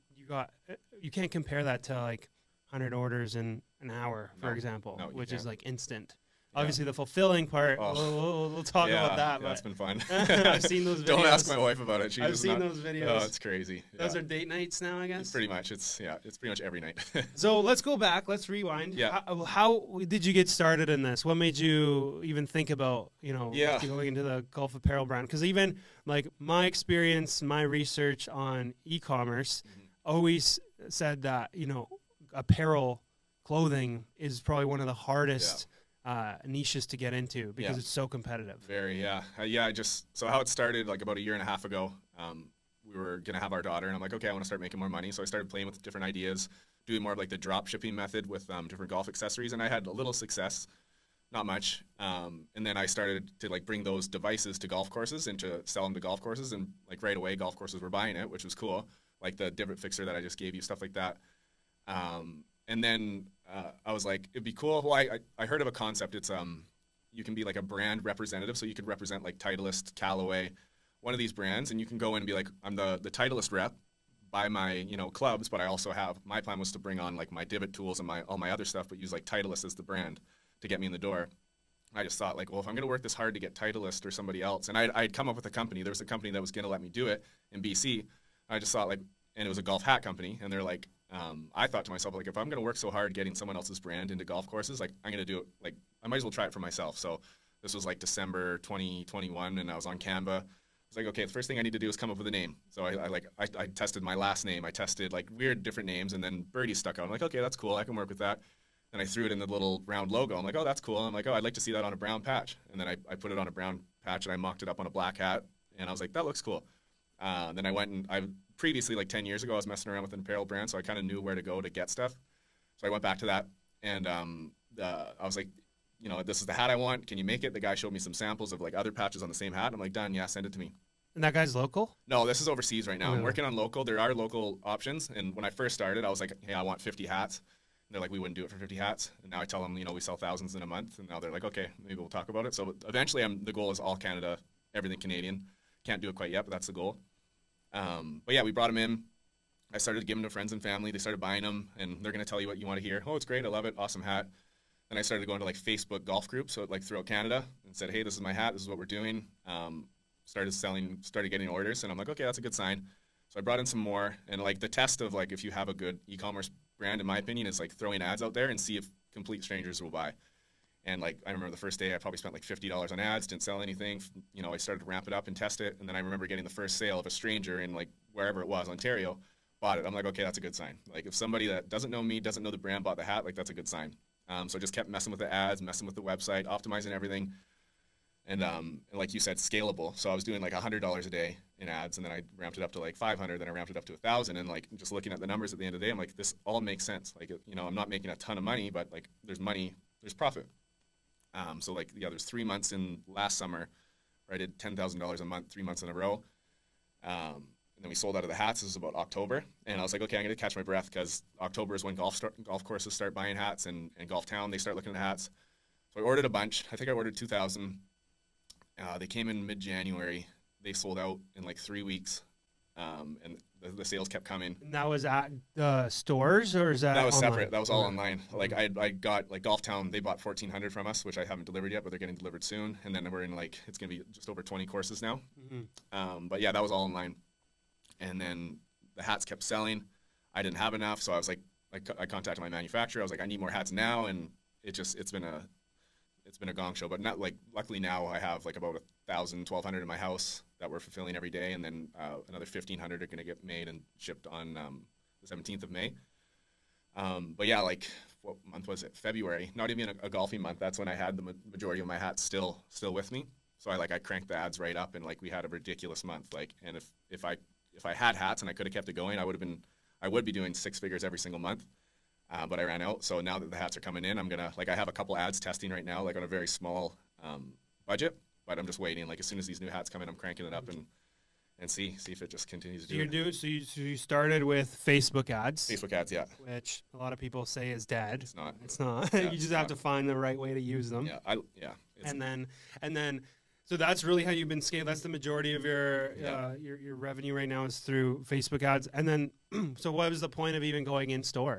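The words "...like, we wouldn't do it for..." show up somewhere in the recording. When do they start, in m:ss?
2:18.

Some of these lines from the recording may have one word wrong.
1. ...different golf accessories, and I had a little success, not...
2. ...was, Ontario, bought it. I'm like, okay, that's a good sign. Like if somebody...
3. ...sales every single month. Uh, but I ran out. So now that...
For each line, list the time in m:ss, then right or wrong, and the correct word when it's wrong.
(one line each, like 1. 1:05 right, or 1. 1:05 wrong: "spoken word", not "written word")
1. 0:48 right
2. 2:58 right
3. 4:30 wrong: "figures", not "sales".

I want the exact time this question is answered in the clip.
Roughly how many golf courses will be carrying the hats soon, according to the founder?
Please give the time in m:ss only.
3:54.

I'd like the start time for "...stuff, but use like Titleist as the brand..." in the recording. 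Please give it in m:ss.
1:18.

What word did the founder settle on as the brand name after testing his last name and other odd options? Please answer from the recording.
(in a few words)
Birdie.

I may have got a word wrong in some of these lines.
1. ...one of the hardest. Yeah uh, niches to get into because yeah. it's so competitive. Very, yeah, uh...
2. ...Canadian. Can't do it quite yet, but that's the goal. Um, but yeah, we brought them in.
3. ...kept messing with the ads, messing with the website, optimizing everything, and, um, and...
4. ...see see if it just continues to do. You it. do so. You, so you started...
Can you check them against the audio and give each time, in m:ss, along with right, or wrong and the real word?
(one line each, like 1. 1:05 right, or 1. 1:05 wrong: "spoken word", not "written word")
1. 0:34 right
2. 2:25 right
3. 3:04 right
4. 4:41 right.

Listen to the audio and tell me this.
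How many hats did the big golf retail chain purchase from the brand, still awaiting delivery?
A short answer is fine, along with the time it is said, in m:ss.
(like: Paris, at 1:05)
1400, at 3:50.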